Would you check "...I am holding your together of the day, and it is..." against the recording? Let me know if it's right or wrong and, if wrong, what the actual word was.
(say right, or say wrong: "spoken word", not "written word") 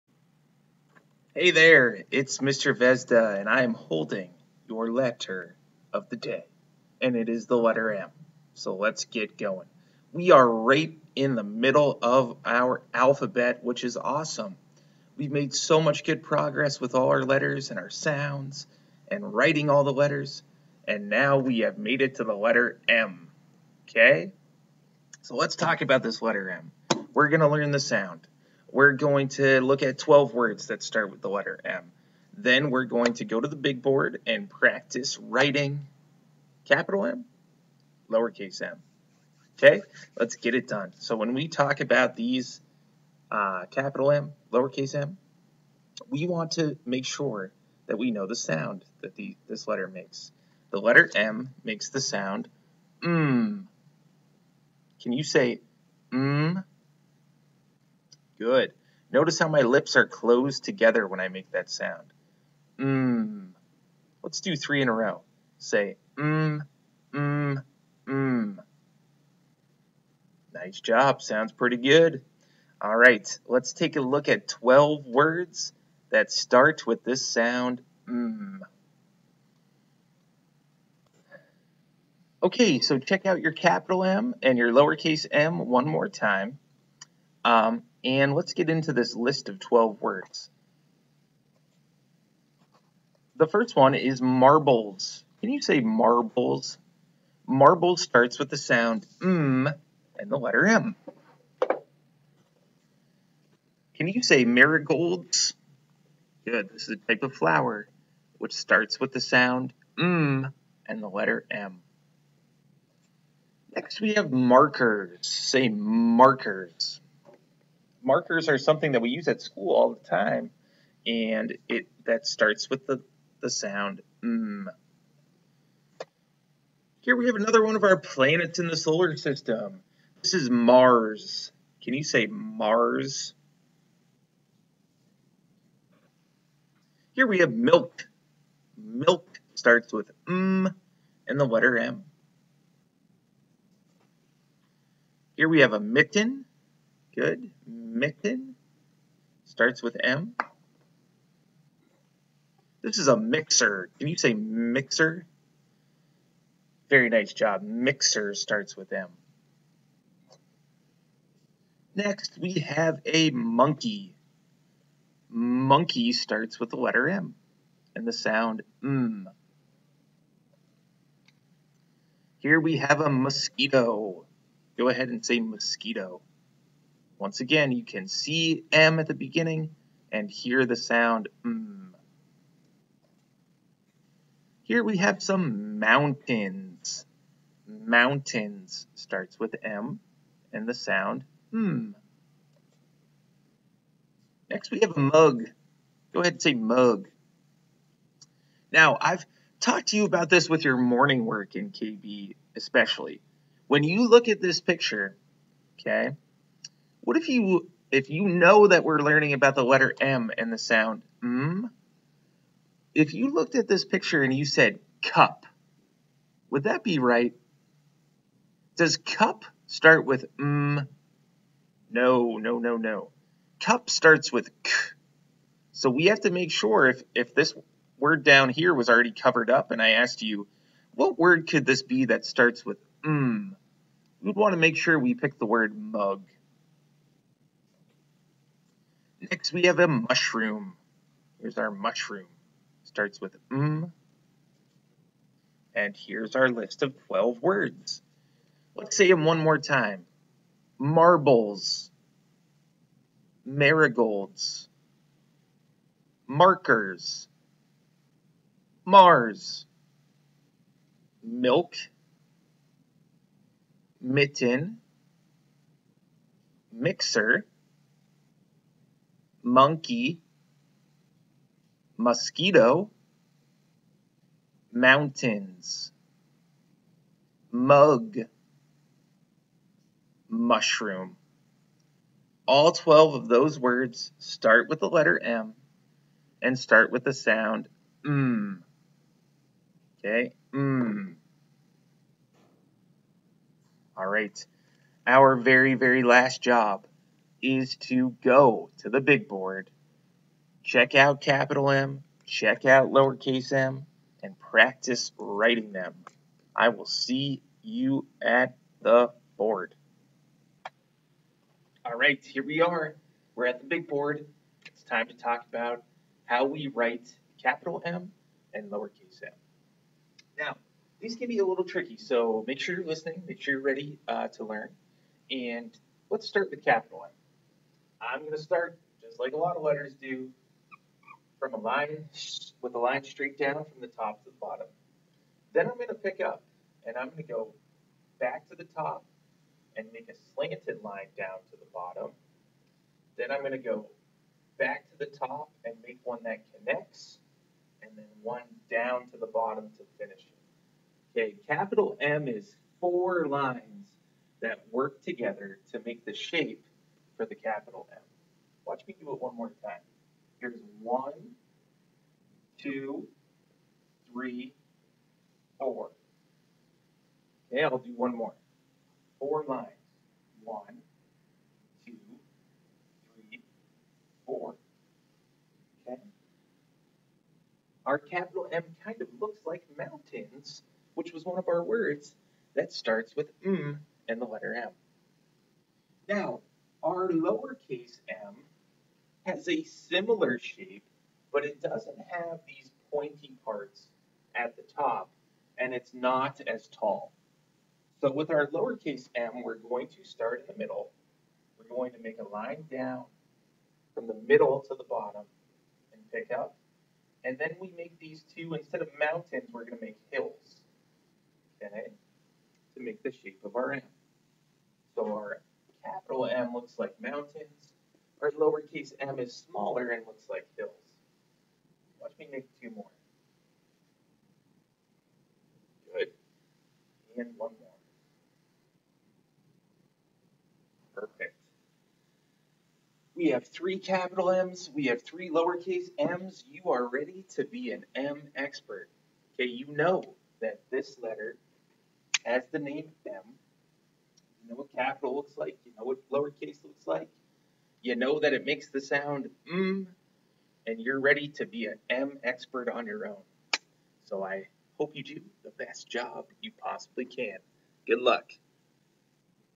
wrong: "letter", not "together".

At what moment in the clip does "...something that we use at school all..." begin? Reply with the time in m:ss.
1:58.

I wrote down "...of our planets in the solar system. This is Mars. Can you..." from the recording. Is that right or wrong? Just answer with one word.
right.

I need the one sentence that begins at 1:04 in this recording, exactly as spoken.
Let's do three in a row.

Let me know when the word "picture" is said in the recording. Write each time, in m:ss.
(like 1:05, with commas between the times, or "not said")
3:24, 3:33.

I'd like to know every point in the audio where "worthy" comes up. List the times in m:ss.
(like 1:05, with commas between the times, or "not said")
not said.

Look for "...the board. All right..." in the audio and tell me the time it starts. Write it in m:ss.
5:08.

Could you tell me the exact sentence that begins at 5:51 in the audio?
Okay, capital M is four lines that work together to make the shape for the capital M.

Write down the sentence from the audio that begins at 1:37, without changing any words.
Marble starts with the sound M and the letter M.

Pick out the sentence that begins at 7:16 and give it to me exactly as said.
You are ready to be an M expert.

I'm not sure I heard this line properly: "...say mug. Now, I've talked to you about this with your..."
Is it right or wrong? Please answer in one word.
right.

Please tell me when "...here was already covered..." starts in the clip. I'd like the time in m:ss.
3:48.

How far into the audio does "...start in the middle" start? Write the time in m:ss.
6:40.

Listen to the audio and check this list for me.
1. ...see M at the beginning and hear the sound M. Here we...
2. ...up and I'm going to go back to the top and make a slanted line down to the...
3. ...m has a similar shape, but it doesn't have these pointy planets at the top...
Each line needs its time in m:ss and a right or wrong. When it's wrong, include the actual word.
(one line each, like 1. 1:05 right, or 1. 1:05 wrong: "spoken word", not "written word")
1. 2:58 right
2. 5:36 right
3. 6:28 wrong: "parts", not "planets".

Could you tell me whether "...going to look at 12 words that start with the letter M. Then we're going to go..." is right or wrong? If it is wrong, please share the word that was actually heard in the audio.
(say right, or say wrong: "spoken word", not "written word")
right.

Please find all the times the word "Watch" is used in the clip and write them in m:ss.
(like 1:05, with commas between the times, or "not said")
5:58, 7:01.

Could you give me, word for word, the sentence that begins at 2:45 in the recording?
Monkey starts with the letter M and the sound M.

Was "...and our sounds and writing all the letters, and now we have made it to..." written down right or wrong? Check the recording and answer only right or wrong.
right.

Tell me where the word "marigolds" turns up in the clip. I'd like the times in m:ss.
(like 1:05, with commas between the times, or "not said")
1:44, 4:13.